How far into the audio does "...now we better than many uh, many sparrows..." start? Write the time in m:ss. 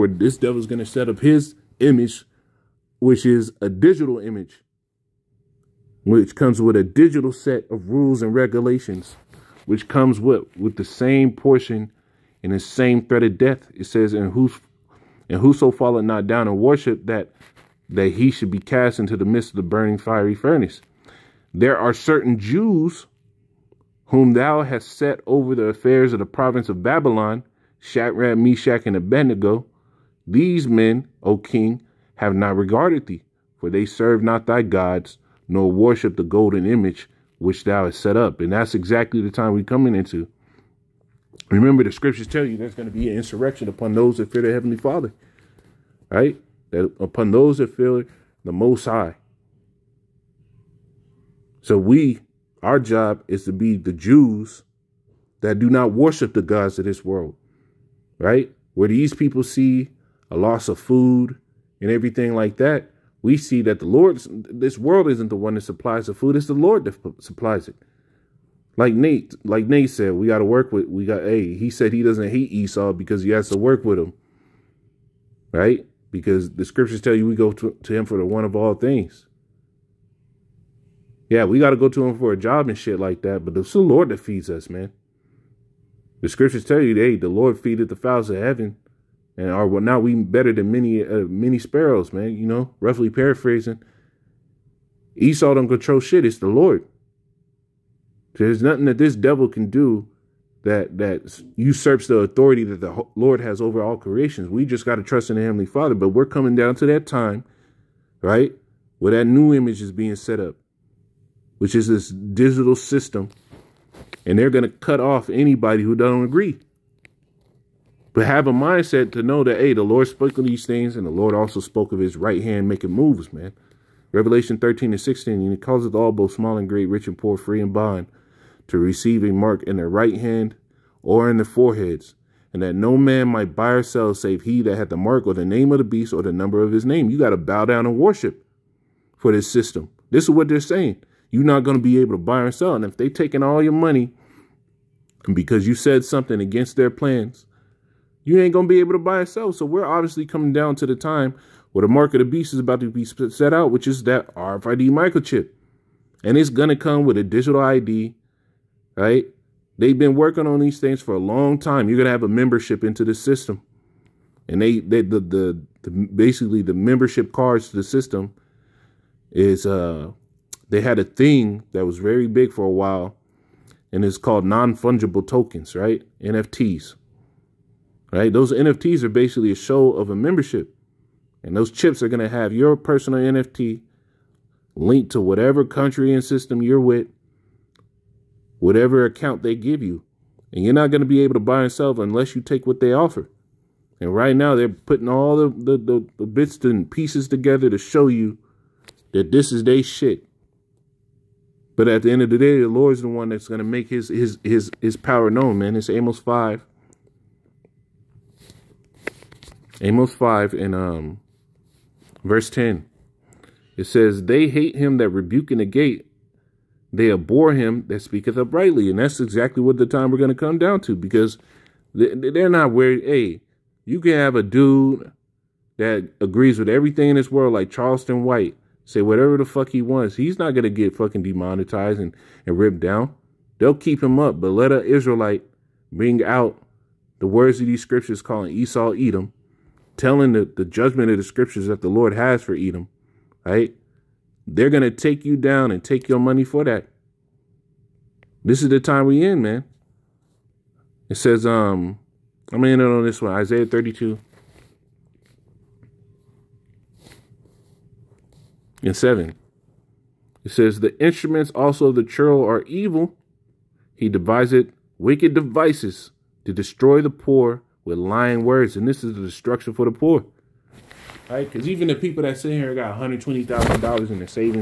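1:29.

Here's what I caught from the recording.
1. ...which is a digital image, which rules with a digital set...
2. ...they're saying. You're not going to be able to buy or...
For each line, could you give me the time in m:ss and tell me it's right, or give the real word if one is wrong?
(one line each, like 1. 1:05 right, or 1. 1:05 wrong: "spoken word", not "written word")
1. 0:02 wrong: "comes", not "rules"
2. 2:20 right.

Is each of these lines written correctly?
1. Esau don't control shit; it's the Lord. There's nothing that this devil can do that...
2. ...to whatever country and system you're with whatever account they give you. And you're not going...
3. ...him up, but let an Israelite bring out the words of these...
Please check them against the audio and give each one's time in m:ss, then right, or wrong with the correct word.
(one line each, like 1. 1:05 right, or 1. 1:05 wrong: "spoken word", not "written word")
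1. 1:35 right
2. 3:05 right
3. 3:54 right.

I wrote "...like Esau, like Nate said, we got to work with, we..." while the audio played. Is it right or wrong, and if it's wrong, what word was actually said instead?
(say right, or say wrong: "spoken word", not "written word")
wrong: "Nate", not "Esau".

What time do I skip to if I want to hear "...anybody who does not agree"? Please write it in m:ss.
1:55.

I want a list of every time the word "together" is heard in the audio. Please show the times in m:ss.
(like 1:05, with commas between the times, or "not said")
3:17.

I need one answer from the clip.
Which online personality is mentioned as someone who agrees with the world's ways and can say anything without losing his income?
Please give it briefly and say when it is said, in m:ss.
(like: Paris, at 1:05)
Charleston White, at 3:47.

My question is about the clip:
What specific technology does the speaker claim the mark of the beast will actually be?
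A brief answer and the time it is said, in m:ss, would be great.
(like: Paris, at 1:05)
RFID microchip, at 2:34.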